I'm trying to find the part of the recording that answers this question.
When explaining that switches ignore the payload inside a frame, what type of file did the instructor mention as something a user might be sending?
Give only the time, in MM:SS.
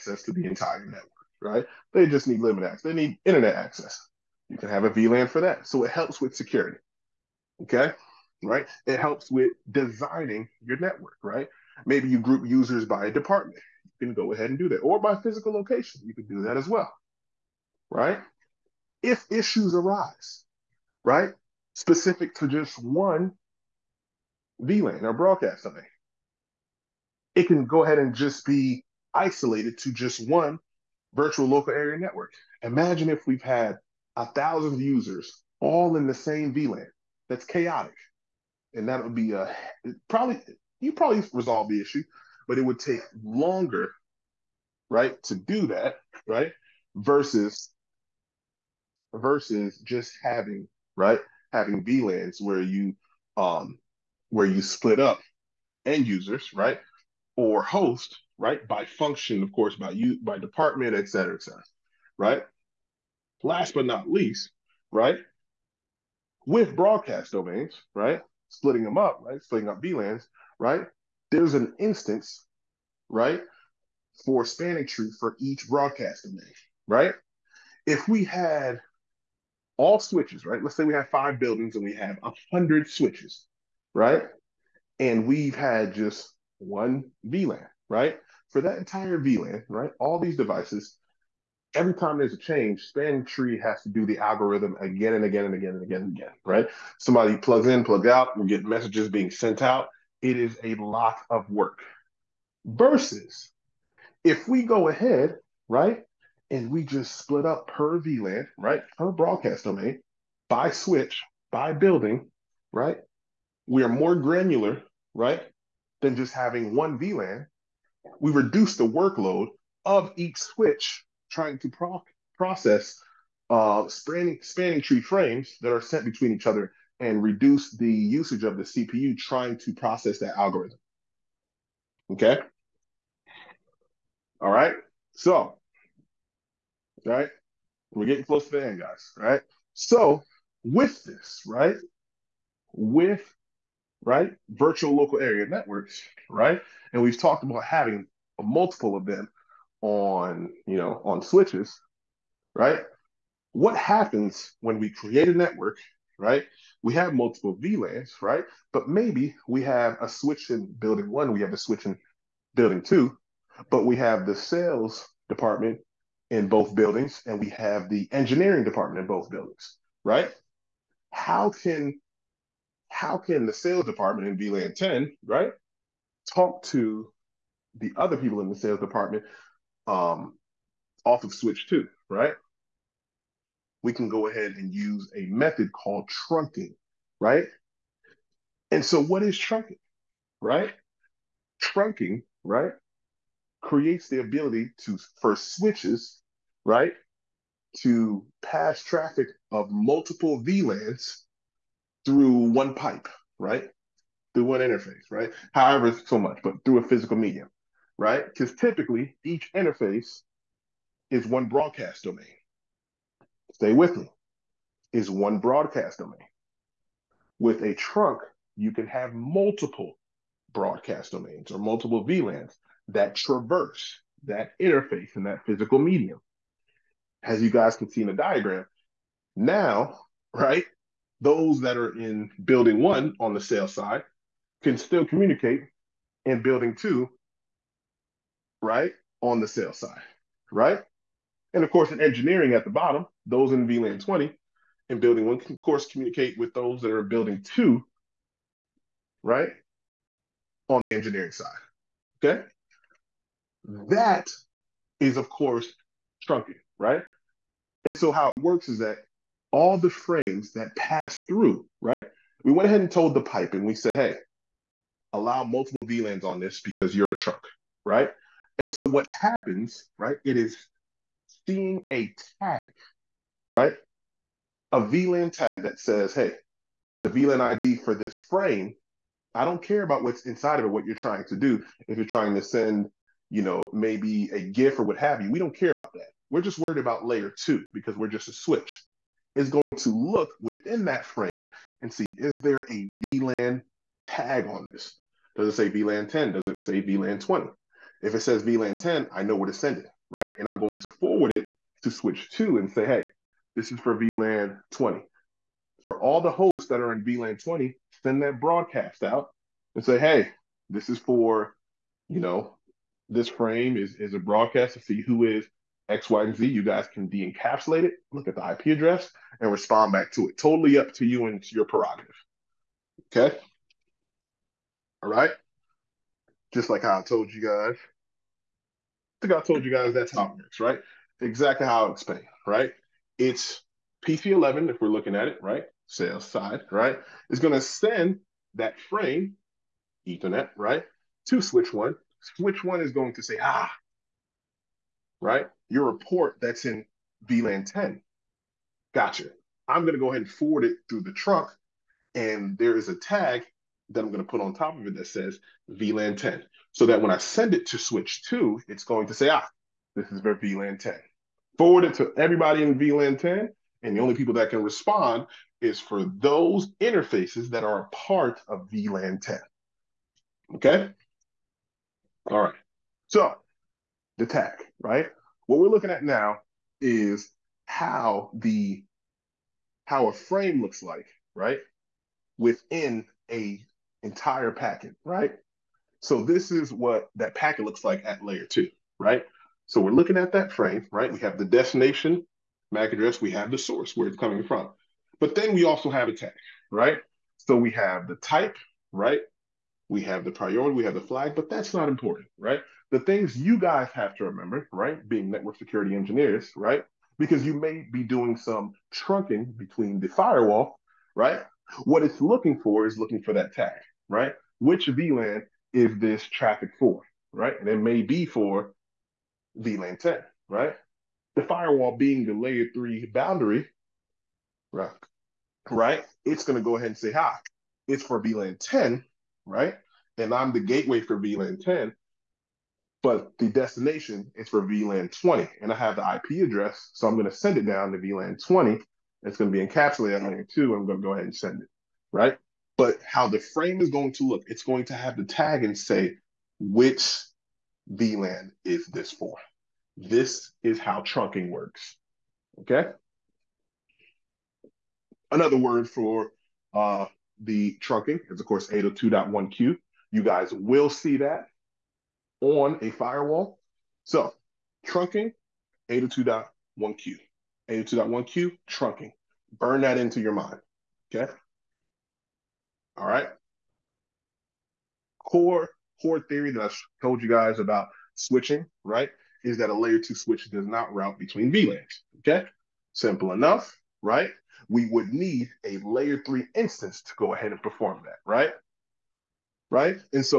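04:44.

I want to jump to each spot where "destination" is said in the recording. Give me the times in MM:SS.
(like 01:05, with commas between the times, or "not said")
06:31, 07:13.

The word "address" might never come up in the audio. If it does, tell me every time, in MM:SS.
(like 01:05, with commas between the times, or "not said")
05:18, 06:32, 07:16.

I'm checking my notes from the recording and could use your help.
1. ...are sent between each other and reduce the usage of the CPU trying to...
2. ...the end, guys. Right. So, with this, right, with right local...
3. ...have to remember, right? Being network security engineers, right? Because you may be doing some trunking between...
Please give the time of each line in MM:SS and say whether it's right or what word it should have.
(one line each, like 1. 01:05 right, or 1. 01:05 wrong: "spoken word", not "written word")
1. 02:05 right
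2. 02:18 wrong: "virtual", not "local"
3. 06:43 right.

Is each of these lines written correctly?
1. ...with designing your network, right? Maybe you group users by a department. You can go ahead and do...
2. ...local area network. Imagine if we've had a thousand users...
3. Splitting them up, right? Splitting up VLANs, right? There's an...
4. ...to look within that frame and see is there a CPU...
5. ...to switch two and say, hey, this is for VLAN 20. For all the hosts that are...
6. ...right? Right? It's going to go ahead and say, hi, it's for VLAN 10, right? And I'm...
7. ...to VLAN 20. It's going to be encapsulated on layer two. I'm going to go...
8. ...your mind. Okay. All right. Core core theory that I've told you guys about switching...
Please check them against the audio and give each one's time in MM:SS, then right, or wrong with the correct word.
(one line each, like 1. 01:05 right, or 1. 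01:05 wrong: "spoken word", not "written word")
1. 00:09 right
2. 00:31 right
3. 01:08 right
4. 04:49 wrong: "VLAN", not "CPU"
5. 05:01 right
6. 07:04 right
7. 07:17 right
8. 07:50 right.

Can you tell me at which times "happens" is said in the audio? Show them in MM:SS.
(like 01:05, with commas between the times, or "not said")
02:33, 04:29.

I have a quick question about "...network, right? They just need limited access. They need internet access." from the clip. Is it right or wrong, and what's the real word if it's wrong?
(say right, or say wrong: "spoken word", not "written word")
right.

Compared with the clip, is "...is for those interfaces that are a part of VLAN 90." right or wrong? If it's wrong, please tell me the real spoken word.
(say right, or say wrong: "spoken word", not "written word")
wrong: "10", not "90".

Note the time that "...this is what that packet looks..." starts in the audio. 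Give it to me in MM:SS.
06:26.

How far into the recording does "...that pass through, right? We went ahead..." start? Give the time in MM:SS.
04:20.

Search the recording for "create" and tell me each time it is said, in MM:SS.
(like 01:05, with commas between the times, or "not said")
02:34, 03:13.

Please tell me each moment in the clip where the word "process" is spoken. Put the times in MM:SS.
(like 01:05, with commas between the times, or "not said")
02:02, 02:09.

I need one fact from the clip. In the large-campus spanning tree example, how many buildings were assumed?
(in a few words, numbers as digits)
5.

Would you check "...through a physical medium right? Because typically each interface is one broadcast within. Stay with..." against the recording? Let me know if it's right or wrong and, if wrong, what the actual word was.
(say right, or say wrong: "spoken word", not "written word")
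wrong: "domain", not "within".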